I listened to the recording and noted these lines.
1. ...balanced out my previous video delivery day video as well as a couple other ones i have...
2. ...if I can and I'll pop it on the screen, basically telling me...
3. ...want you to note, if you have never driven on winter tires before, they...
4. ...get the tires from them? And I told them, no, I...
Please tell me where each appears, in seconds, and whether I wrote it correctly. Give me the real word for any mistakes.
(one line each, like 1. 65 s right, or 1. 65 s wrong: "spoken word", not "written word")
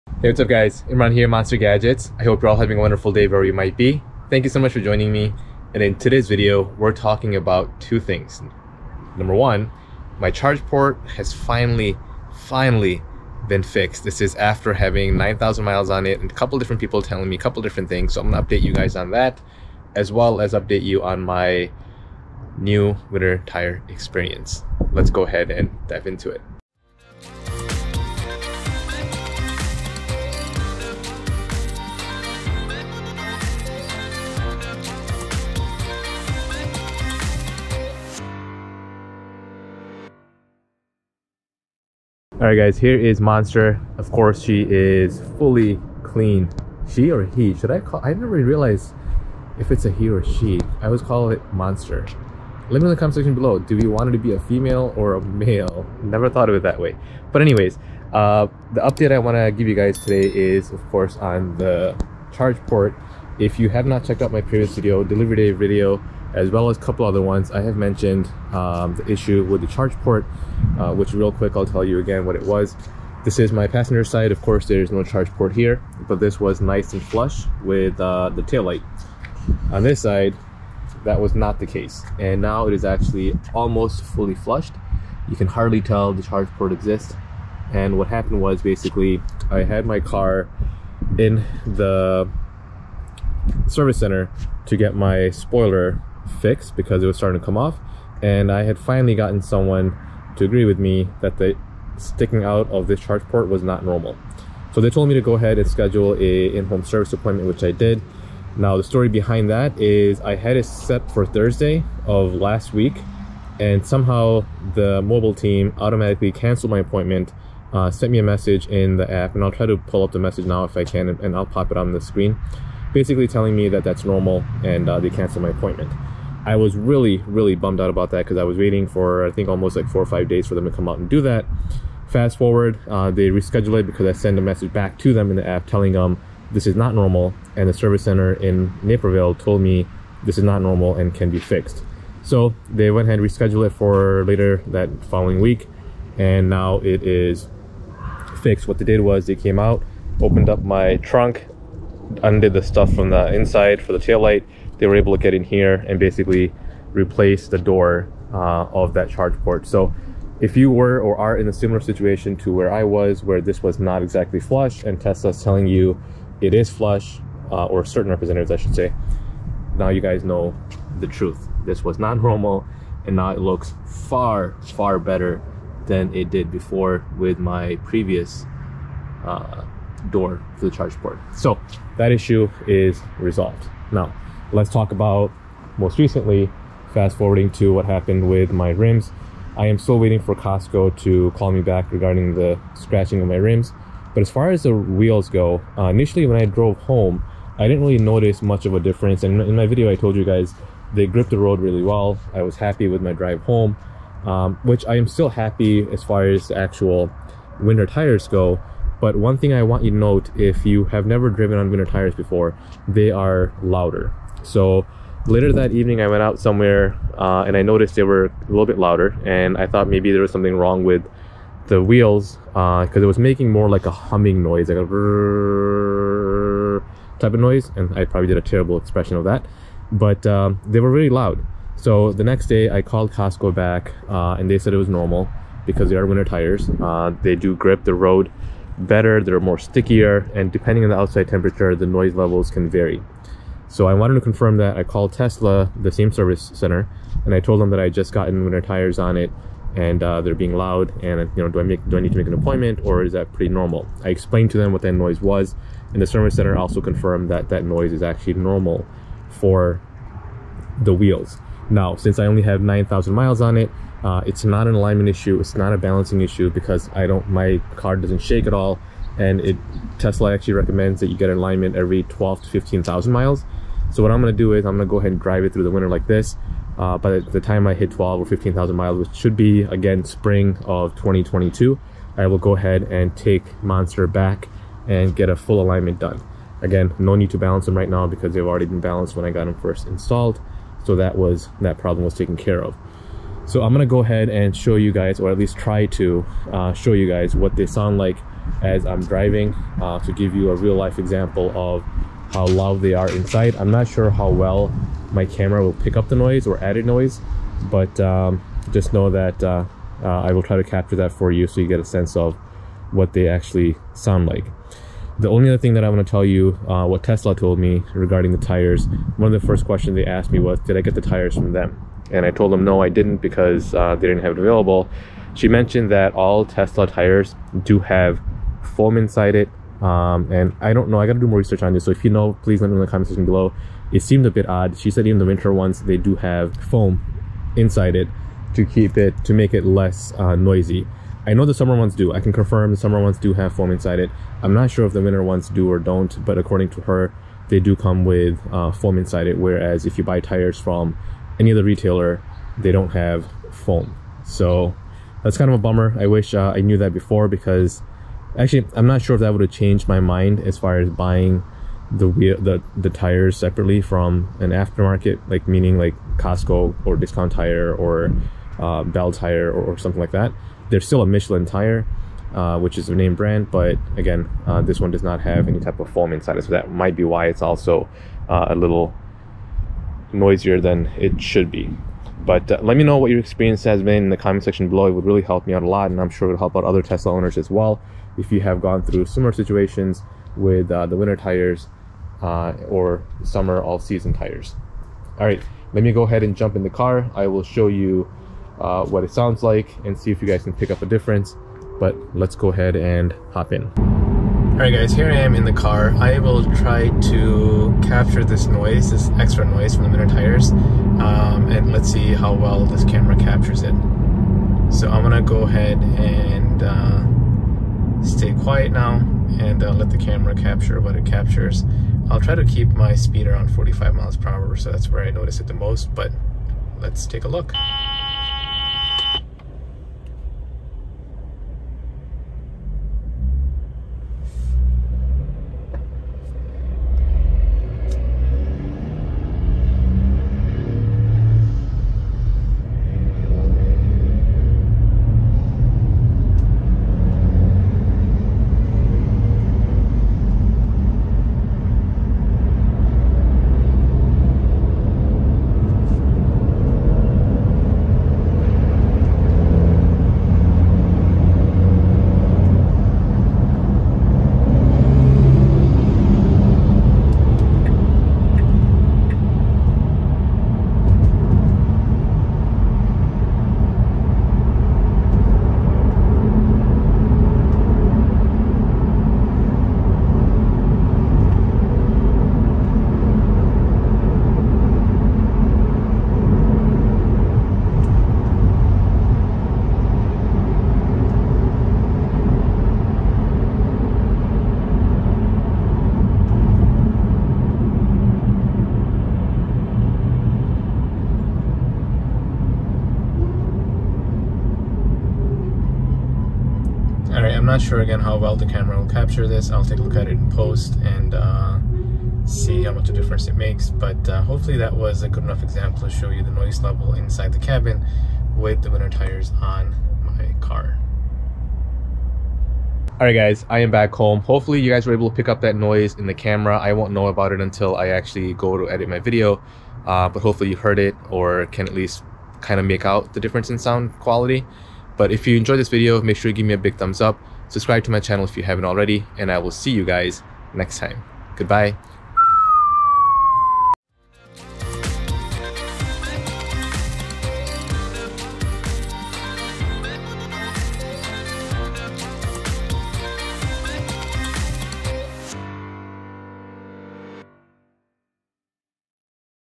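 1. 64 s wrong: "checked", not "balanced"
2. 120 s right
3. 209 s right
4. 320 s right.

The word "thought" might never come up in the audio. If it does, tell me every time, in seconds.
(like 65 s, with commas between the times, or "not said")
56 s, 219 s.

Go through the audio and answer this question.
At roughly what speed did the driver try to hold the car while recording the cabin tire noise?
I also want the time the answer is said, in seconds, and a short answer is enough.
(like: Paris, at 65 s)
45 mph, at 423 s.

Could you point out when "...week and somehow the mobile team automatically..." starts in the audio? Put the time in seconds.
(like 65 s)
112 s.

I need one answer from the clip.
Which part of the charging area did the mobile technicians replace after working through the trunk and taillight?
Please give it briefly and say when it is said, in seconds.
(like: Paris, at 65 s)
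The door, at 157 s.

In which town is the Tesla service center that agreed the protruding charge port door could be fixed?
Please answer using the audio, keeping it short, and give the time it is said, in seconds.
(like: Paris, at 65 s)
Naperville, at 138 s.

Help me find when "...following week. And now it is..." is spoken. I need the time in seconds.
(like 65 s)
145 s.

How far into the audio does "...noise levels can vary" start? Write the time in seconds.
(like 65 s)
241 s.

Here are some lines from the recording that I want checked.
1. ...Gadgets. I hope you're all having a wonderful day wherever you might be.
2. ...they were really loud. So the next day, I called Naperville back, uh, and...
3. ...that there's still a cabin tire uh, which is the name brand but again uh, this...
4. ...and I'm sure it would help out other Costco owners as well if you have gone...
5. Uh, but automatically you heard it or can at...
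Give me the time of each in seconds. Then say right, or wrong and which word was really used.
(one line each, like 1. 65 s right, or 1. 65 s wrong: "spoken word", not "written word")
1. 1 s right
2. 230 s wrong: "Costco", not "Naperville"
3. 370 s wrong: "michelin", not "cabin"
4. 385 s wrong: "Tesla", not "Costco"
5. 529 s wrong: "hopefully", not "automatically".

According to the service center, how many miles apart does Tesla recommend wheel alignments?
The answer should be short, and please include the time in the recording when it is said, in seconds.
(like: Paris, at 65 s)
12 to 15,000 miles, at 272 s.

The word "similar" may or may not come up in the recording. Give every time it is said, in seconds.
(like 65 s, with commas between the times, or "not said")
161 s, 389 s.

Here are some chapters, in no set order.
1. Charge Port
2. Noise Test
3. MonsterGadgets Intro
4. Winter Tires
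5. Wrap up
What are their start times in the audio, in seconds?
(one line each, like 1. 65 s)
1. 42 s
2. 403 s
3. 26 s
4. 183 s
5. 522 s.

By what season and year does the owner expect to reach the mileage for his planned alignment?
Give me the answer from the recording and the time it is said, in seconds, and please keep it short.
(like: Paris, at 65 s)
Spring of 2022, at 280 s.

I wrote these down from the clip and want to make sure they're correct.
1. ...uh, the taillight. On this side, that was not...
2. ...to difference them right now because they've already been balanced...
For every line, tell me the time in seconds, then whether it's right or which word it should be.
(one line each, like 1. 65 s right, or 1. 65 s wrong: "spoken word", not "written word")
1. 77 s right
2. 287 s wrong: "balance", not "difference".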